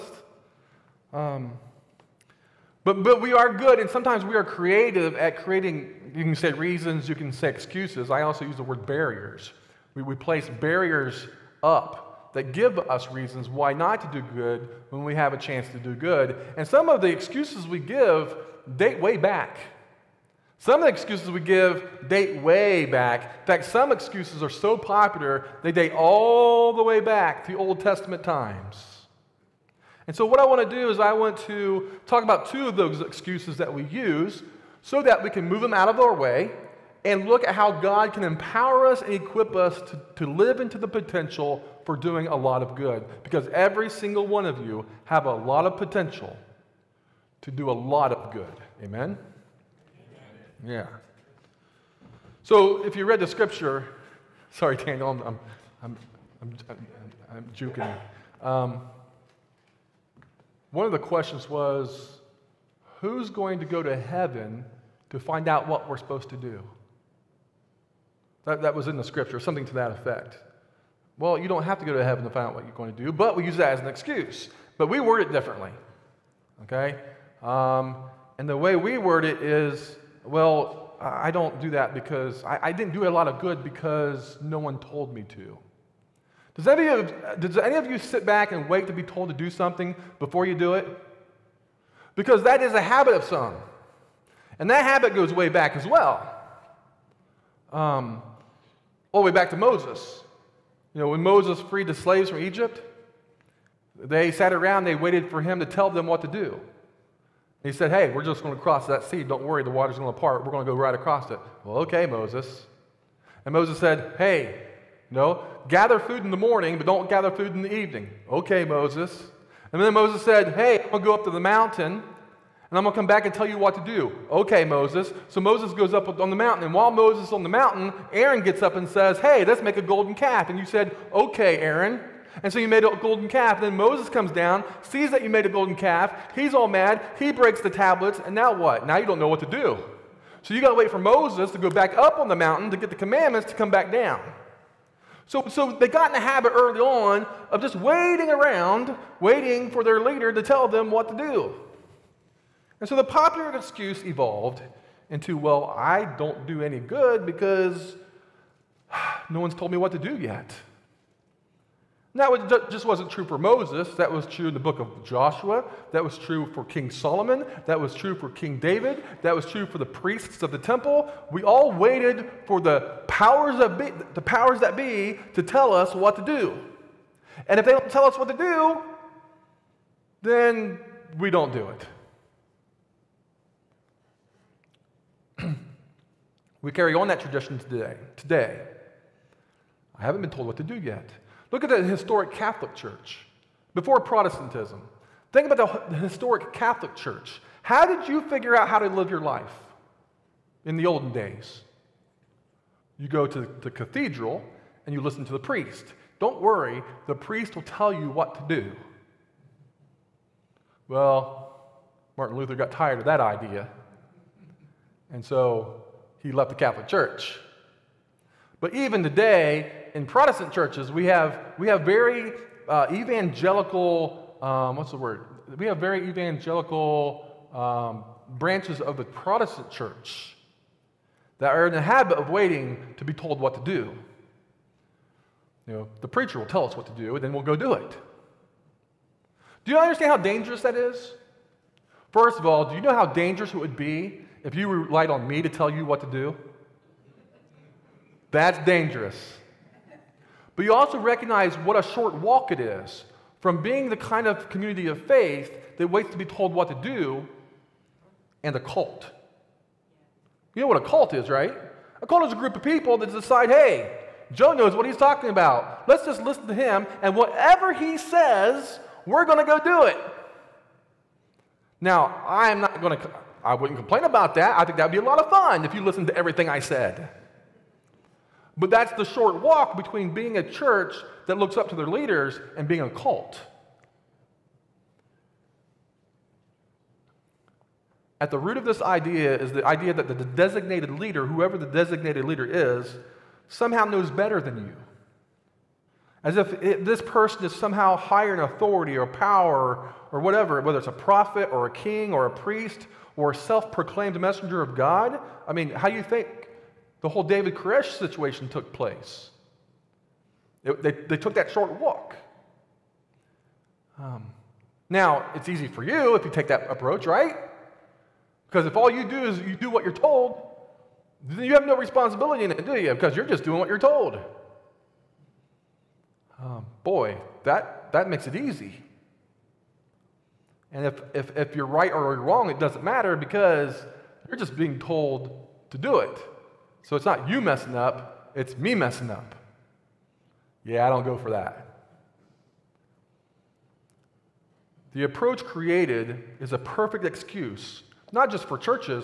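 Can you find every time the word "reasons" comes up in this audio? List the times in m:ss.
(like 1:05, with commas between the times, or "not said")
0:06, 0:13.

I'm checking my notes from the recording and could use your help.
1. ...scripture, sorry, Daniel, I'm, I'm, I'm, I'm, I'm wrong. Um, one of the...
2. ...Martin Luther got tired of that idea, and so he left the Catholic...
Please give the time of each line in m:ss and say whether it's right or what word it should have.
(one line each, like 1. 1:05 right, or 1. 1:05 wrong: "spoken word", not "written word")
1. 0:53 wrong: "juking", not "wrong"
2. 3:32 right.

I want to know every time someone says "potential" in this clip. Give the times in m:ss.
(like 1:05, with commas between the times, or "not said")
0:40, 0:45.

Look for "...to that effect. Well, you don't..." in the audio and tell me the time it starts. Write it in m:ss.
1:09.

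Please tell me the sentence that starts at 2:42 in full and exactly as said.
That was, just wasn't true for Moses.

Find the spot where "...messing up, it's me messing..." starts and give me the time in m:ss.
5:37.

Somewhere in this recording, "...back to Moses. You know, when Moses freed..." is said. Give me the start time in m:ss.
1:39.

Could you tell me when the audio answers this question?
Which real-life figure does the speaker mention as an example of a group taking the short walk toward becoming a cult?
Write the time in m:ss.
5:07.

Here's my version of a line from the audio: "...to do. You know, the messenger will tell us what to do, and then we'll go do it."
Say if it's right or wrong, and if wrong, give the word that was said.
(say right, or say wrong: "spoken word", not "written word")
wrong: "preacher", not "messenger".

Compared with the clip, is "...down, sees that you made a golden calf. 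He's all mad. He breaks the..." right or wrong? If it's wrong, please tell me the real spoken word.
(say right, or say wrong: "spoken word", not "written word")
right.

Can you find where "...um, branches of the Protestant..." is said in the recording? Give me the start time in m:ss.
3:47.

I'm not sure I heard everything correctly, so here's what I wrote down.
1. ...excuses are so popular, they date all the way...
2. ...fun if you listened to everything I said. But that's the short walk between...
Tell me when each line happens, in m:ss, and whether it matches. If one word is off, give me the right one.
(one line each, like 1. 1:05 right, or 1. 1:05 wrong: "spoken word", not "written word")
1. 0:23 right
2. 4:35 right.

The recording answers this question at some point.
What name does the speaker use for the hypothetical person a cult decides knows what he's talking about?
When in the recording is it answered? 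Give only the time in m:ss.
4:24.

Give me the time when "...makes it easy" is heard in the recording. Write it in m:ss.
5:28.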